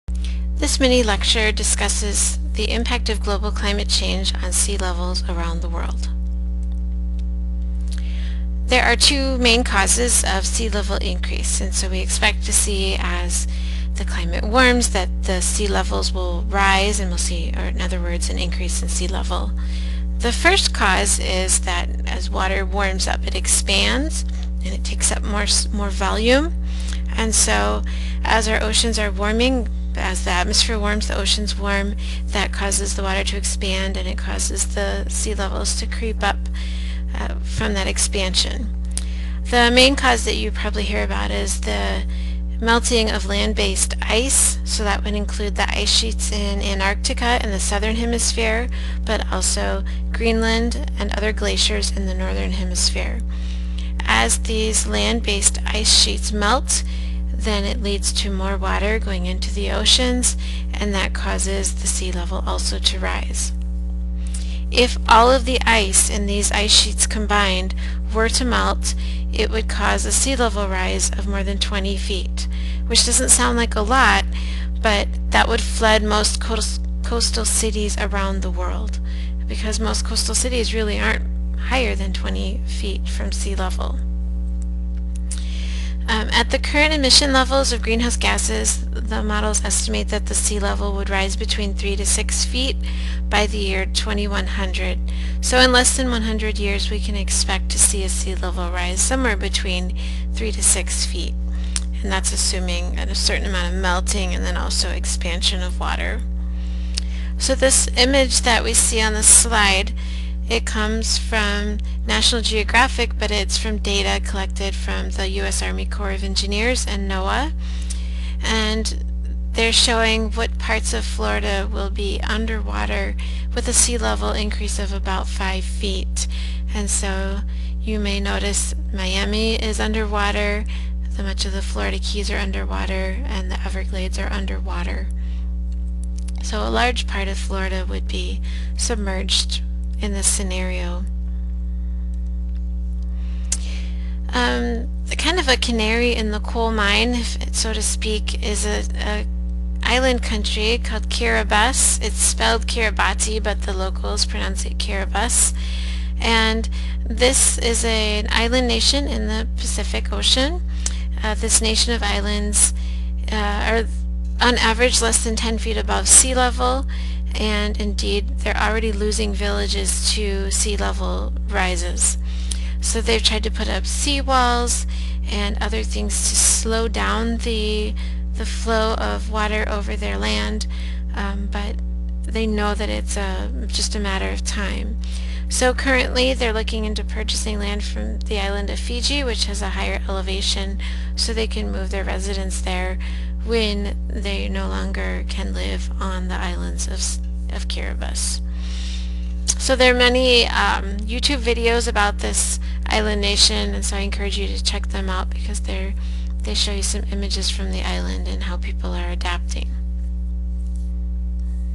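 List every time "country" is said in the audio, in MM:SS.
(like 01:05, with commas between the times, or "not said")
02:30.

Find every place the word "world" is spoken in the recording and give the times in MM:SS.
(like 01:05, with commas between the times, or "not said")
00:05, 01:18.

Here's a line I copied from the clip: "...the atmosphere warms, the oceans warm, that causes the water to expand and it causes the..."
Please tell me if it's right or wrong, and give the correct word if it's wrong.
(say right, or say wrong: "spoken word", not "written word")
right.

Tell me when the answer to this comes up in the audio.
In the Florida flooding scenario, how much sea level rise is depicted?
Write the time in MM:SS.
02:04.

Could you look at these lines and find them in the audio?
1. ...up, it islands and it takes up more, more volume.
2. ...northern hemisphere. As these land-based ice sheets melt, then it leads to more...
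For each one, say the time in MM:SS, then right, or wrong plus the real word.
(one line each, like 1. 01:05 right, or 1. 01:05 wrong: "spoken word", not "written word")
1. 00:23 wrong: "expands", not "islands"
2. 00:52 right.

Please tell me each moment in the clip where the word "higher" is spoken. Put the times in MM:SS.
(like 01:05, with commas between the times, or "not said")
01:21, 03:09.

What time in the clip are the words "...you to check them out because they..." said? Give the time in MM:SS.
03:24.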